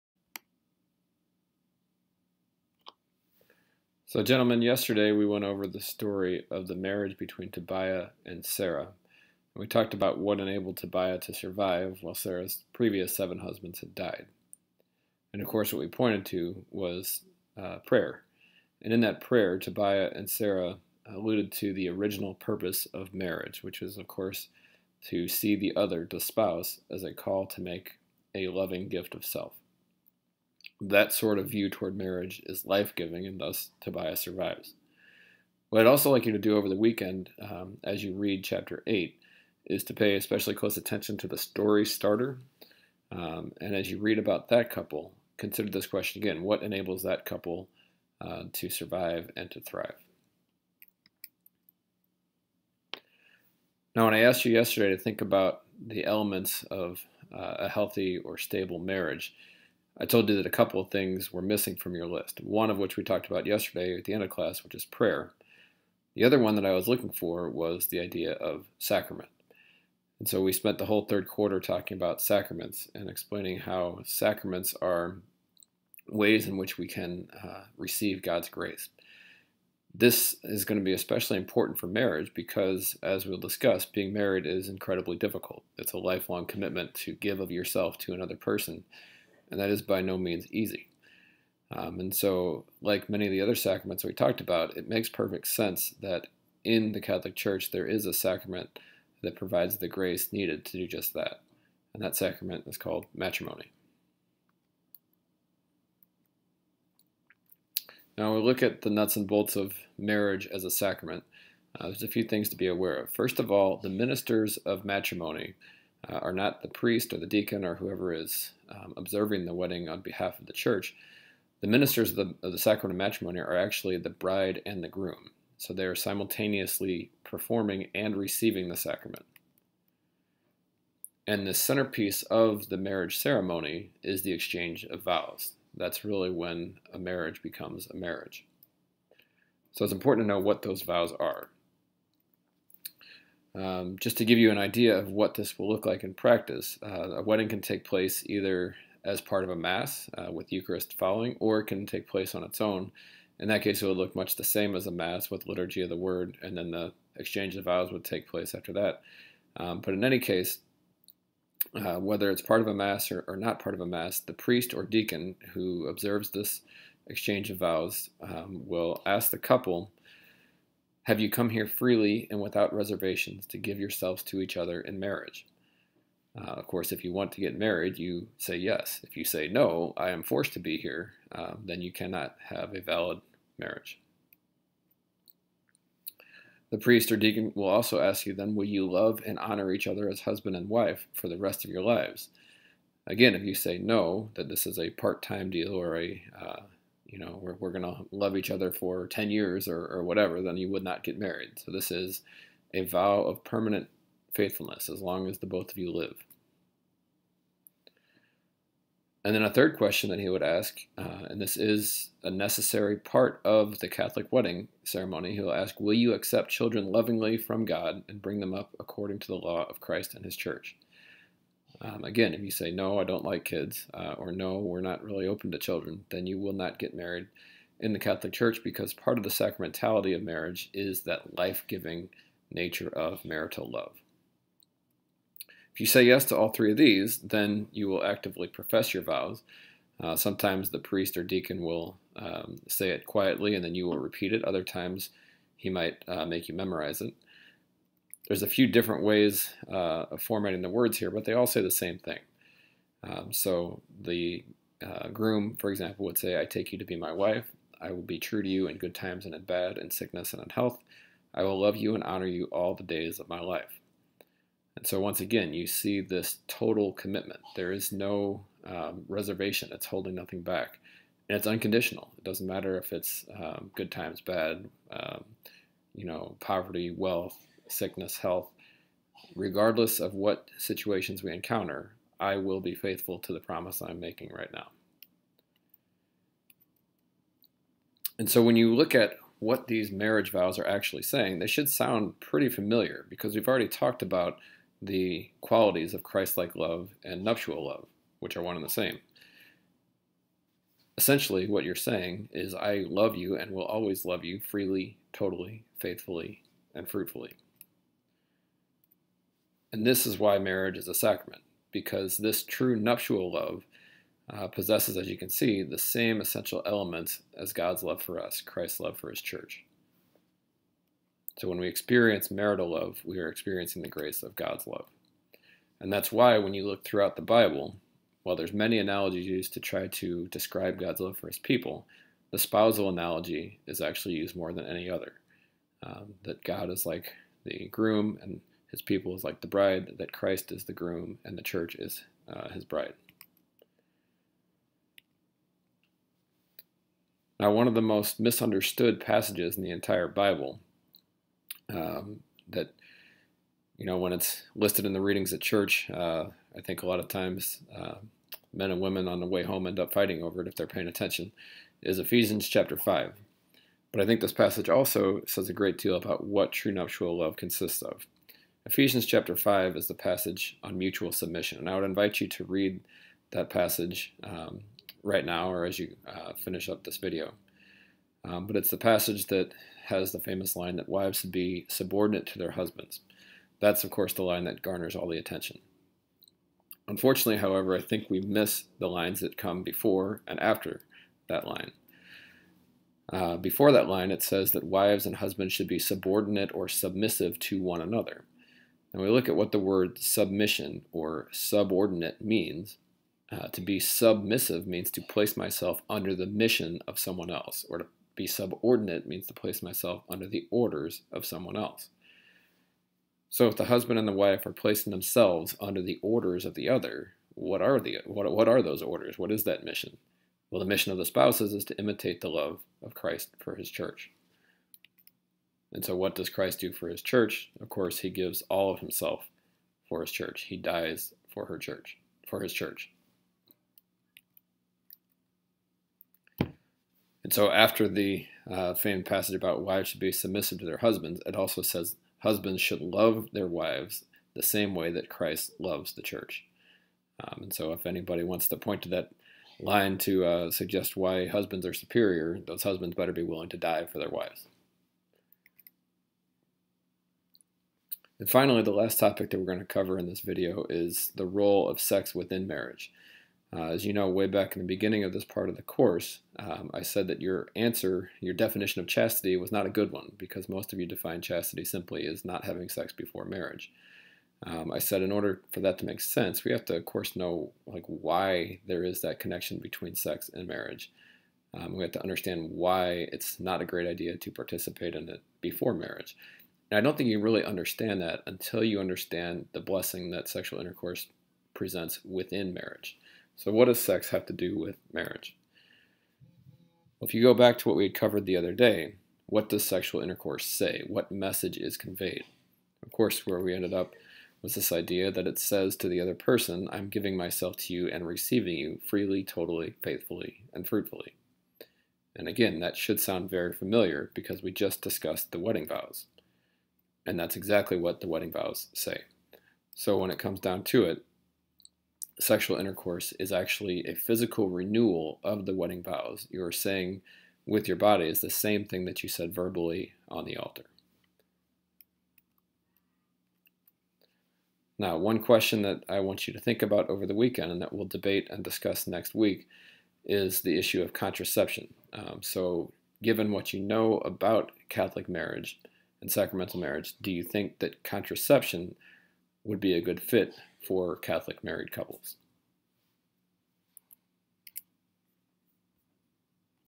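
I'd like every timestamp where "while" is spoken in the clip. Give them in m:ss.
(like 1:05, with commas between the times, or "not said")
0:12, 5:28.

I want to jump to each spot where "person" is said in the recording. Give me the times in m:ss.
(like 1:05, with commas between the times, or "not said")
1:28, 8:26.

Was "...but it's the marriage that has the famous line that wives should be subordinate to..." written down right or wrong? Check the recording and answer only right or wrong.
wrong.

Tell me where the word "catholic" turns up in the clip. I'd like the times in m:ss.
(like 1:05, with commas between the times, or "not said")
1:37, 3:33, 3:47, 9:04, 9:10.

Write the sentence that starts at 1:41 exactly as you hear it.
And that sacrament is called matrimony.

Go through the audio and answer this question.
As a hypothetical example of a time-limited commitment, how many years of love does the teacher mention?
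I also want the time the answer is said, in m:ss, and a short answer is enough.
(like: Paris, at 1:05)
10, at 3:19.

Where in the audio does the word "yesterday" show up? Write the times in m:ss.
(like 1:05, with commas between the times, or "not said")
0:04, 0:54, 1:03.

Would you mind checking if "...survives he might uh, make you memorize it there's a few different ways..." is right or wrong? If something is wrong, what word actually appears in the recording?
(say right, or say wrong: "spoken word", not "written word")
wrong: "times", not "survives".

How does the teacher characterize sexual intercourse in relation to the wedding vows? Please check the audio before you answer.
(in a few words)
physical renewal.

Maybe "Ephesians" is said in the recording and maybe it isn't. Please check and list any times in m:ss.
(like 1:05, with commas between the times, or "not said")
6:01, 6:08.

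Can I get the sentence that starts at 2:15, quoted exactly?
That's really when a marriage becomes a marriage.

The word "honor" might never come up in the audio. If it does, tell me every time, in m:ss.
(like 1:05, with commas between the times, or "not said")
3:09, 4:22.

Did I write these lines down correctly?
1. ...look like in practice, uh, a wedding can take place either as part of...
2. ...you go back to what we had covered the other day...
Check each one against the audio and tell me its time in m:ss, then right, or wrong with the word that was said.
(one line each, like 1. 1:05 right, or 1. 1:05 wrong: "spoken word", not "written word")
1. 2:25 right
2. 8:17 right.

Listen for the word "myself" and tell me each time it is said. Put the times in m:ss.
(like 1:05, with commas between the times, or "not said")
6:45, 6:49, 8:27.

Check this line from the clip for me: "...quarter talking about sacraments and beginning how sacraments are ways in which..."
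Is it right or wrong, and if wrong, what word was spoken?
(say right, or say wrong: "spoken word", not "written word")
wrong: "explaining", not "beginning".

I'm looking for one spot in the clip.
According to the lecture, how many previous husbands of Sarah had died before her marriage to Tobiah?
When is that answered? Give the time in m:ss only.
0:13.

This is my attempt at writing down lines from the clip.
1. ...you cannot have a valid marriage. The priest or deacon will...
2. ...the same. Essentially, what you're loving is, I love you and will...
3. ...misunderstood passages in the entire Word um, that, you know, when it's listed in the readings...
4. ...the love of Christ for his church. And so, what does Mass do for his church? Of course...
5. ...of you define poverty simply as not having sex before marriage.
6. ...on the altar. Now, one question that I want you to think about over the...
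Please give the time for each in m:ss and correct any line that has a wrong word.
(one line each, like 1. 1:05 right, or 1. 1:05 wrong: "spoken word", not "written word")
1. 3:01 right
2. 4:58 wrong: "saying", not "loving"
3. 5:48 wrong: "Bible", not "Word"
4. 7:02 wrong: "Christ", not "Mass"
5. 7:50 wrong: "chastity", not "poverty"
6. 8:50 right.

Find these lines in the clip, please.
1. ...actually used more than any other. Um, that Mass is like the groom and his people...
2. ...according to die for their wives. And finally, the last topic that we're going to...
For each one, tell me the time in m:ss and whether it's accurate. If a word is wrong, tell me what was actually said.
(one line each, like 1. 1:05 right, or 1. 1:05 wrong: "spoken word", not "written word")
1. 5:33 wrong: "God", not "Mass"
2. 7:33 wrong: "willing", not "according".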